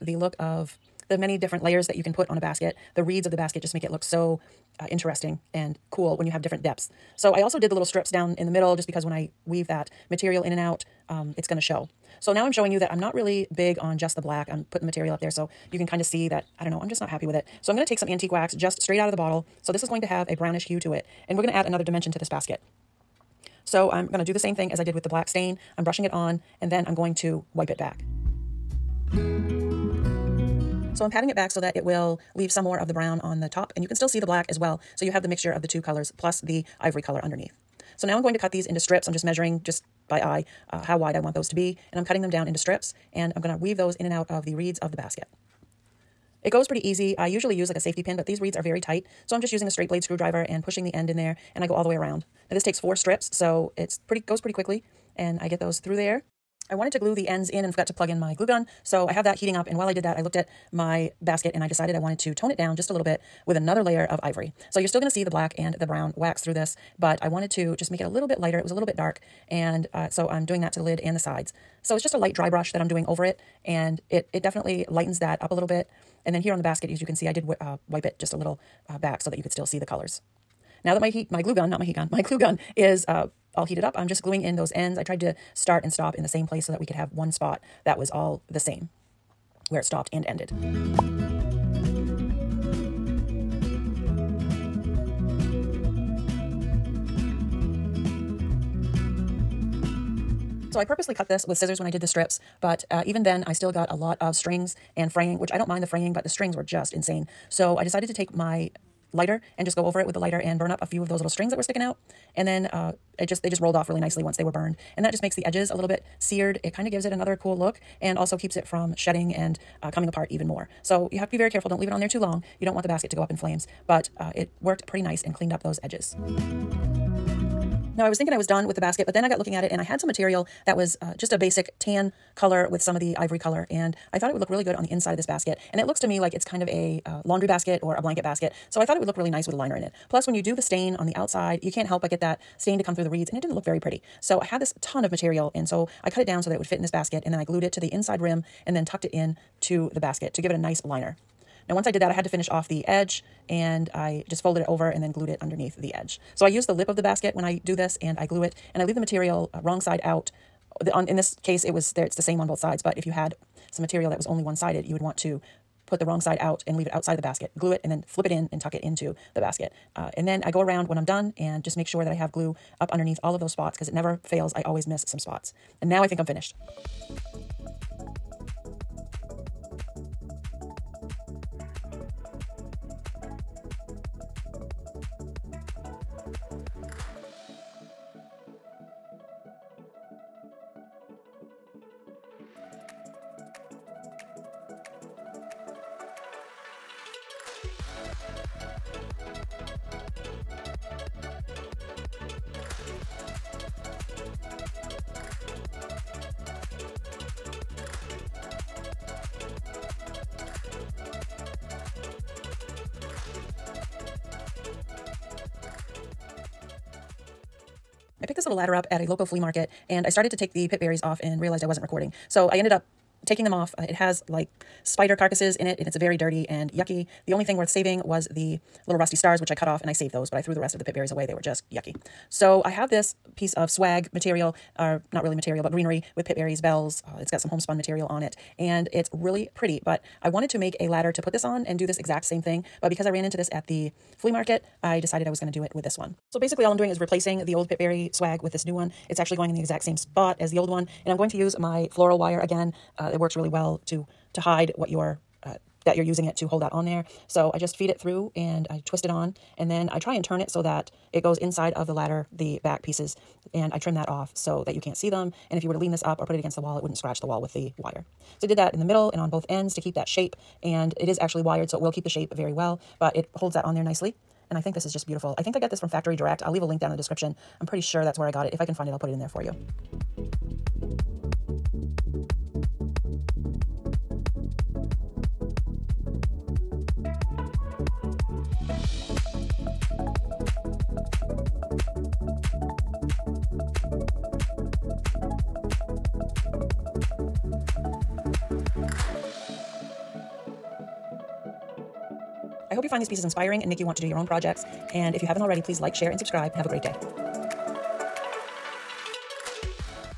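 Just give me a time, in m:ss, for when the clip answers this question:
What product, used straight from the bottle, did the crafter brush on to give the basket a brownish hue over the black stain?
0:18.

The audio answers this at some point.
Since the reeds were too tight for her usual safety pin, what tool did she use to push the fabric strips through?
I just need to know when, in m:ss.
0:49.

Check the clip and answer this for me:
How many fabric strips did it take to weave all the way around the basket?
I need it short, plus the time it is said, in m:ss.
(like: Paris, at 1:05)
4, at 0:52.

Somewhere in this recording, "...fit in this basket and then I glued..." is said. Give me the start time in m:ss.
2:26.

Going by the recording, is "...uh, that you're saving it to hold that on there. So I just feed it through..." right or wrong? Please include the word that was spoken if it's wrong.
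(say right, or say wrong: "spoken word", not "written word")
wrong: "using", not "saving".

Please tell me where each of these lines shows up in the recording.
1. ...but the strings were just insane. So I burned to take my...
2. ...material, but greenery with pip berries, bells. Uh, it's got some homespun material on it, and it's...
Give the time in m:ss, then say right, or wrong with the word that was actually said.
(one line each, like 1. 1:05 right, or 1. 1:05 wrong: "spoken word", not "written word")
1. 1:46 wrong: "decided", not "burned"
2. 3:55 right.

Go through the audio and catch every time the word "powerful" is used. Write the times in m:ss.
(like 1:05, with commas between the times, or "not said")
not said.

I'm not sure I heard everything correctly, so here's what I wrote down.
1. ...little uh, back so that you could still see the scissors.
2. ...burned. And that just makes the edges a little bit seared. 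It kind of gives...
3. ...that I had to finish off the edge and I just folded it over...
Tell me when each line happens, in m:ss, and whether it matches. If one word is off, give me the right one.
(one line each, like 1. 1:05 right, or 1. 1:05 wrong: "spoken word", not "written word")
1. 1:18 wrong: "colors", not "scissors"
2. 1:54 right
3. 2:32 right.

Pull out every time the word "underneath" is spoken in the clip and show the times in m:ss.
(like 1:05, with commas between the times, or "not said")
0:37, 2:35, 2:52.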